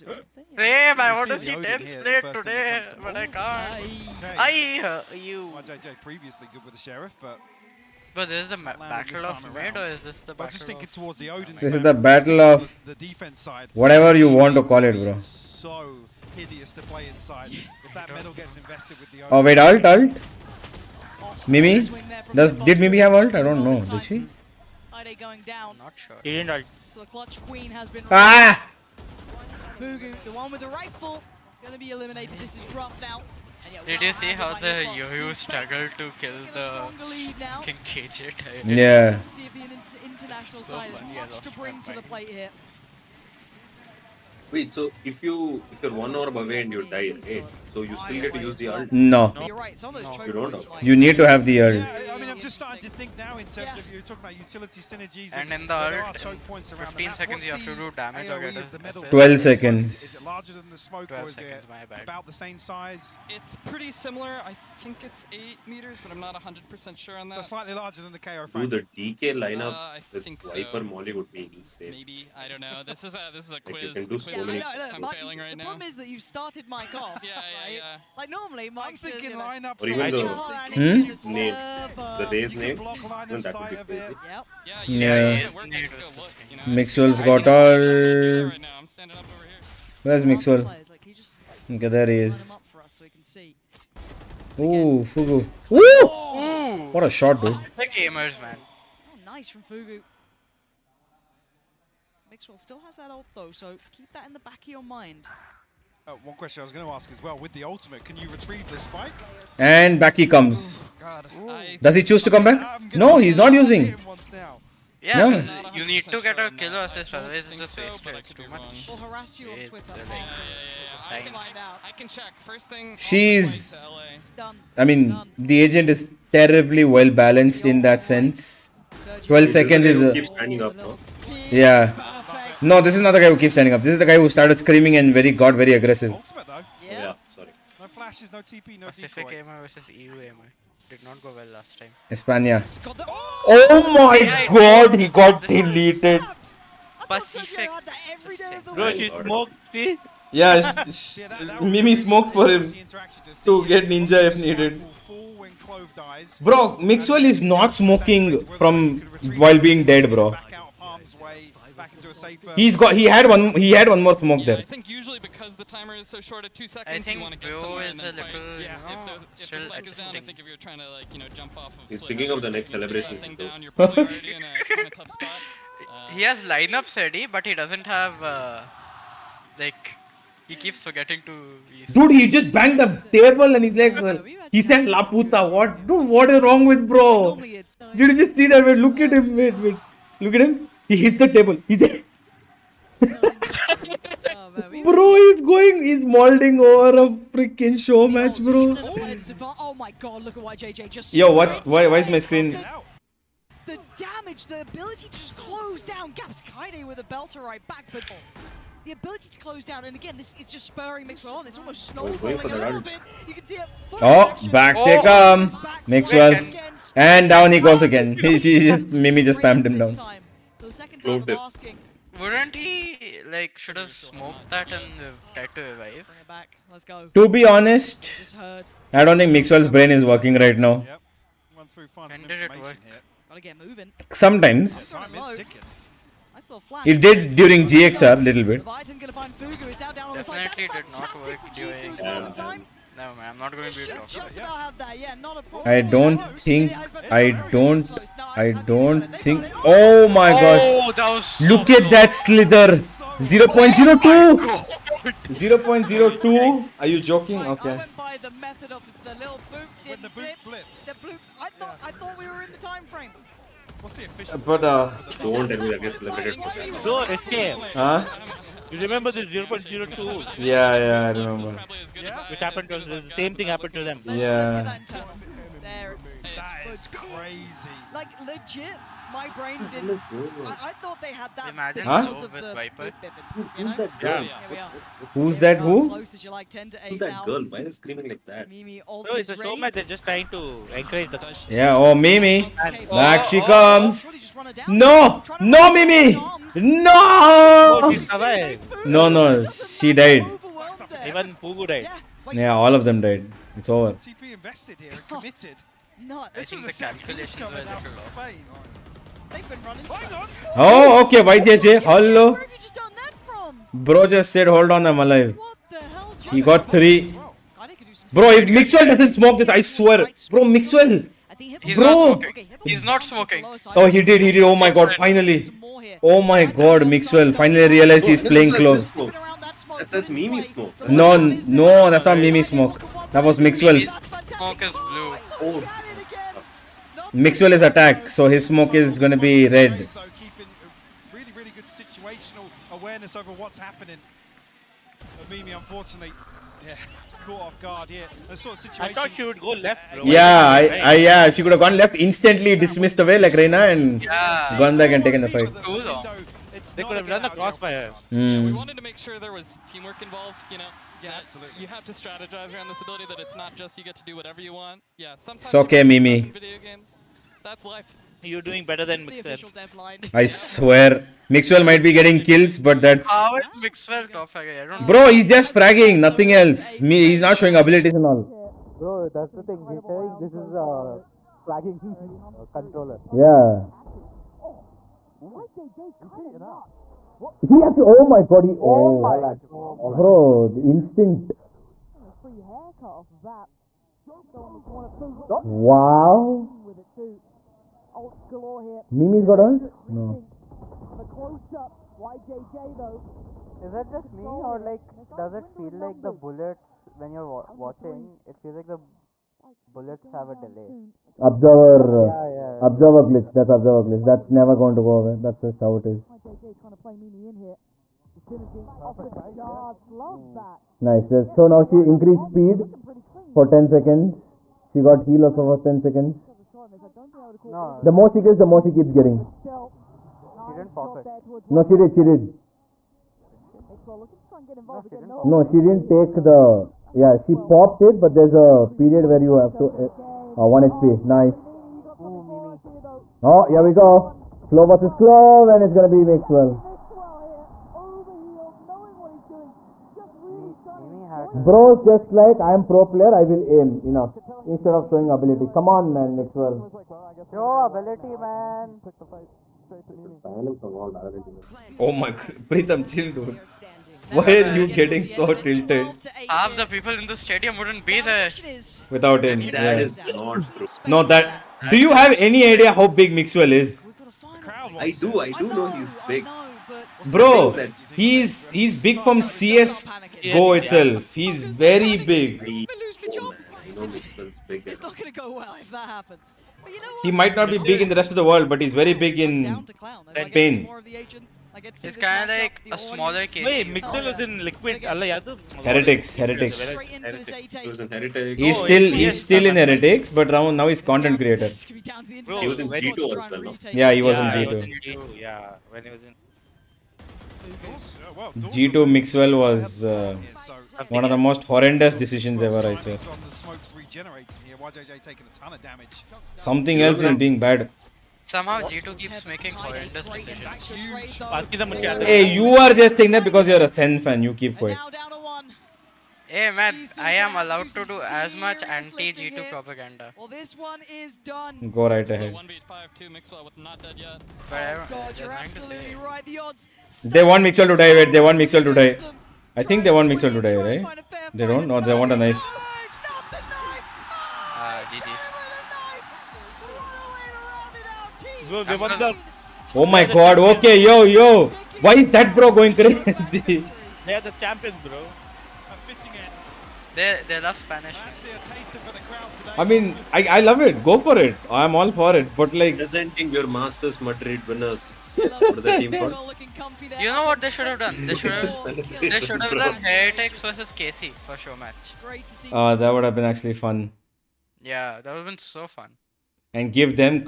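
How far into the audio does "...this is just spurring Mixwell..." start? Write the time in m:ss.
3:30.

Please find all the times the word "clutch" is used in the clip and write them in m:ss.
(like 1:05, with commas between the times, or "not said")
0:27.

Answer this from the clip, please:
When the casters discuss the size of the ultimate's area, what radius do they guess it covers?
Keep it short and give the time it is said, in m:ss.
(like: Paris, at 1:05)
8 meters, at 1:05.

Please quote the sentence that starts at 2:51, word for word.
Of He's thinking of the next celebration.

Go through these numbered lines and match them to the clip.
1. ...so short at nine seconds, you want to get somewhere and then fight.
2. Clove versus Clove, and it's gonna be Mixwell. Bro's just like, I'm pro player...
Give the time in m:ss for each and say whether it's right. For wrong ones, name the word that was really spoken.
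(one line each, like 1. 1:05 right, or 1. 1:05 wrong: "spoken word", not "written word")
1. 2:46 wrong: "two", not "nine"
2. 7:24 right.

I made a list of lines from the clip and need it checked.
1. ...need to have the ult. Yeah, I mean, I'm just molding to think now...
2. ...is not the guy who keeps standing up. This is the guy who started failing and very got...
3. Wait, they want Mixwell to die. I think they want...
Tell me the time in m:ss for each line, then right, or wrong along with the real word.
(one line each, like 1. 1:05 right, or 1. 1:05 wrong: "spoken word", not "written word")
1. 0:50 wrong: "starting", not "molding"
2. 2:12 wrong: "screaming", not "failing"
3. 8:57 right.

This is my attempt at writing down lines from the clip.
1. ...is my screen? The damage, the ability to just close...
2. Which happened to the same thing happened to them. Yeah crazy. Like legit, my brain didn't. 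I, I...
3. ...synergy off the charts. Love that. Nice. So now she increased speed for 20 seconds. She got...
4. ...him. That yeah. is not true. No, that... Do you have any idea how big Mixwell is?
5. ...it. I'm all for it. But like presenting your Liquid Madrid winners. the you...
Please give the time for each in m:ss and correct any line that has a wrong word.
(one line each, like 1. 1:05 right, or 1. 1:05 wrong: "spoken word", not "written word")
1. 3:21 right
2. 4:32 right
3. 6:58 wrong: "10", not "20"
4. 7:49 right
5. 9:21 wrong: "Masters", not "Liquid".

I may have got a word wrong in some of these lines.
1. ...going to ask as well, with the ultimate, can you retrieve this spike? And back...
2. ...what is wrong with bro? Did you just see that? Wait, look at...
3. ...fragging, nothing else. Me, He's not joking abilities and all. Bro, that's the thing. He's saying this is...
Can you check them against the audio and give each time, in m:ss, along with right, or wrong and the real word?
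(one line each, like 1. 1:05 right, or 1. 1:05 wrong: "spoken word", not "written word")
1. 1:46 right
2. 3:06 right
3. 6:15 wrong: "showing", not "joking".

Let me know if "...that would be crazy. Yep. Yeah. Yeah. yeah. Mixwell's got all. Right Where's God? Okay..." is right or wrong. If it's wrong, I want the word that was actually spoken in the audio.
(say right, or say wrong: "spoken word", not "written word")
wrong: "Mixwell", not "God".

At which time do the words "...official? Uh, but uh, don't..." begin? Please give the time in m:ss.
4:24.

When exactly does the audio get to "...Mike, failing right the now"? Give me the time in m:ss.
1:15.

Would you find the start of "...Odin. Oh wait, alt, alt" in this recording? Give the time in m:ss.
0:19.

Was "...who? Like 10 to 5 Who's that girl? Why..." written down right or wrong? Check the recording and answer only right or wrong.
wrong.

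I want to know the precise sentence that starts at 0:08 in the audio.
But this is the battle of mid, or is this the battle?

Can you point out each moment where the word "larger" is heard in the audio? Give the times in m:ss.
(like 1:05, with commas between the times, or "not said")
1:00, 1:07.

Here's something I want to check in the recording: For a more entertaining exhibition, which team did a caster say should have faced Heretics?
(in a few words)
KC.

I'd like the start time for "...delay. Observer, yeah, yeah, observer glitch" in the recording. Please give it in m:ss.
6:50.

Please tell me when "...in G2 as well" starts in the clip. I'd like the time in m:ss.
8:22.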